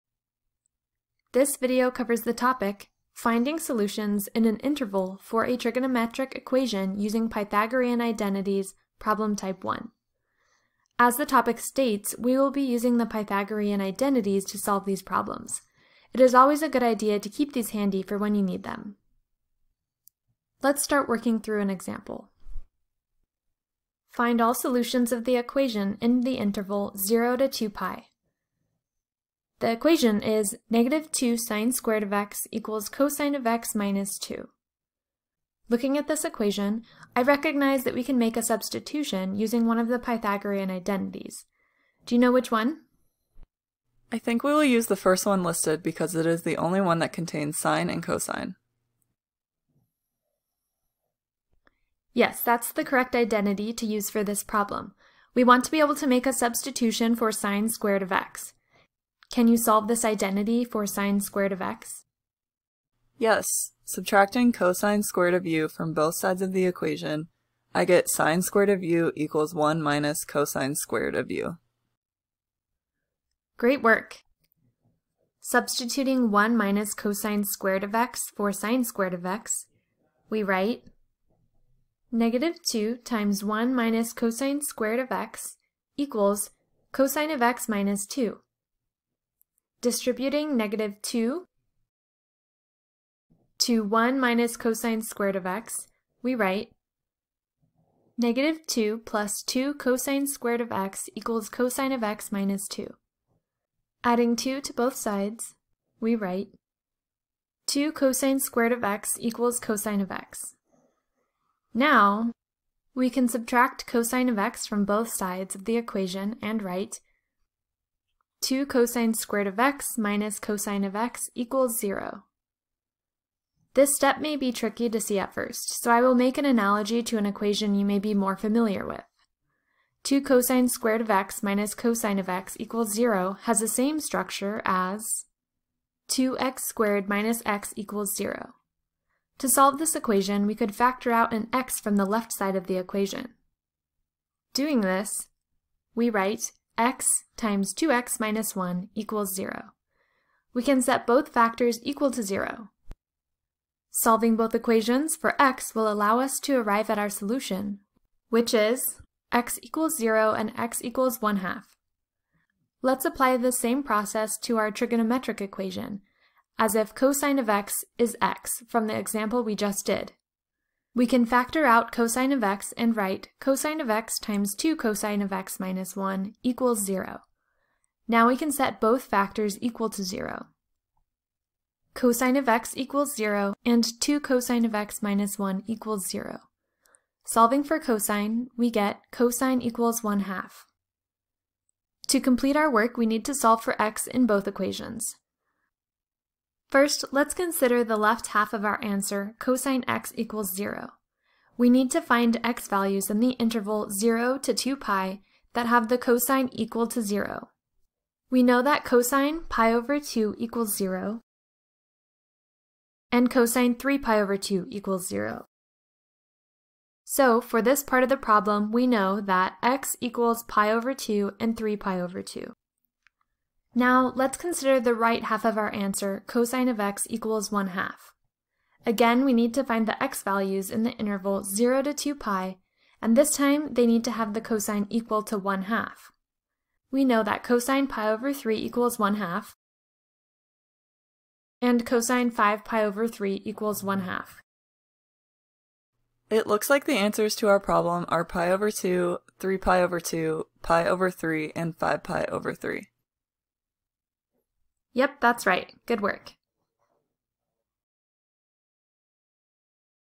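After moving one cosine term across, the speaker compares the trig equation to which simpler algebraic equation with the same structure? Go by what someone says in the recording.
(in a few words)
2x squared minus x equals 0.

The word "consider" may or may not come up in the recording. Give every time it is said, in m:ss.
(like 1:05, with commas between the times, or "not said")
3:17, 3:44.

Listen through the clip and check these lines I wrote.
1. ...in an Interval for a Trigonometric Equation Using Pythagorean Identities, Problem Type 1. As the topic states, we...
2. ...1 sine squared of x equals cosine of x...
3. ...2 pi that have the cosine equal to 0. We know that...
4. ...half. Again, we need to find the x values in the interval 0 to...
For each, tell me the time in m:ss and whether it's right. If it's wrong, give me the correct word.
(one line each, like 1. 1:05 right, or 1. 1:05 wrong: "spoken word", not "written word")
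1. 0:04 right
2. 0:31 wrong: "2", not "1"
3. 3:24 right
4. 3:47 right.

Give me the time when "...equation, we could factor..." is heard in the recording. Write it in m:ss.
2:19.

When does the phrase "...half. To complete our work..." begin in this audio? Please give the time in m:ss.
3:10.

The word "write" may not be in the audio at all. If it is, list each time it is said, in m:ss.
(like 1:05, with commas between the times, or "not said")
1:20, 1:36, 1:46, 1:56, 2:26, 2:52.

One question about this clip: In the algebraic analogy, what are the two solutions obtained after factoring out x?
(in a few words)
0 and 1/2.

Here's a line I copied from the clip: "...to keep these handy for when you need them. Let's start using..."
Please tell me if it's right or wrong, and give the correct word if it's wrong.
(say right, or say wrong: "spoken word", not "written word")
wrong: "working", not "using".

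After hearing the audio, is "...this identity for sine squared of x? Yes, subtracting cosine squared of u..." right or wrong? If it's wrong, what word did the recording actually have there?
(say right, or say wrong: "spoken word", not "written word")
right.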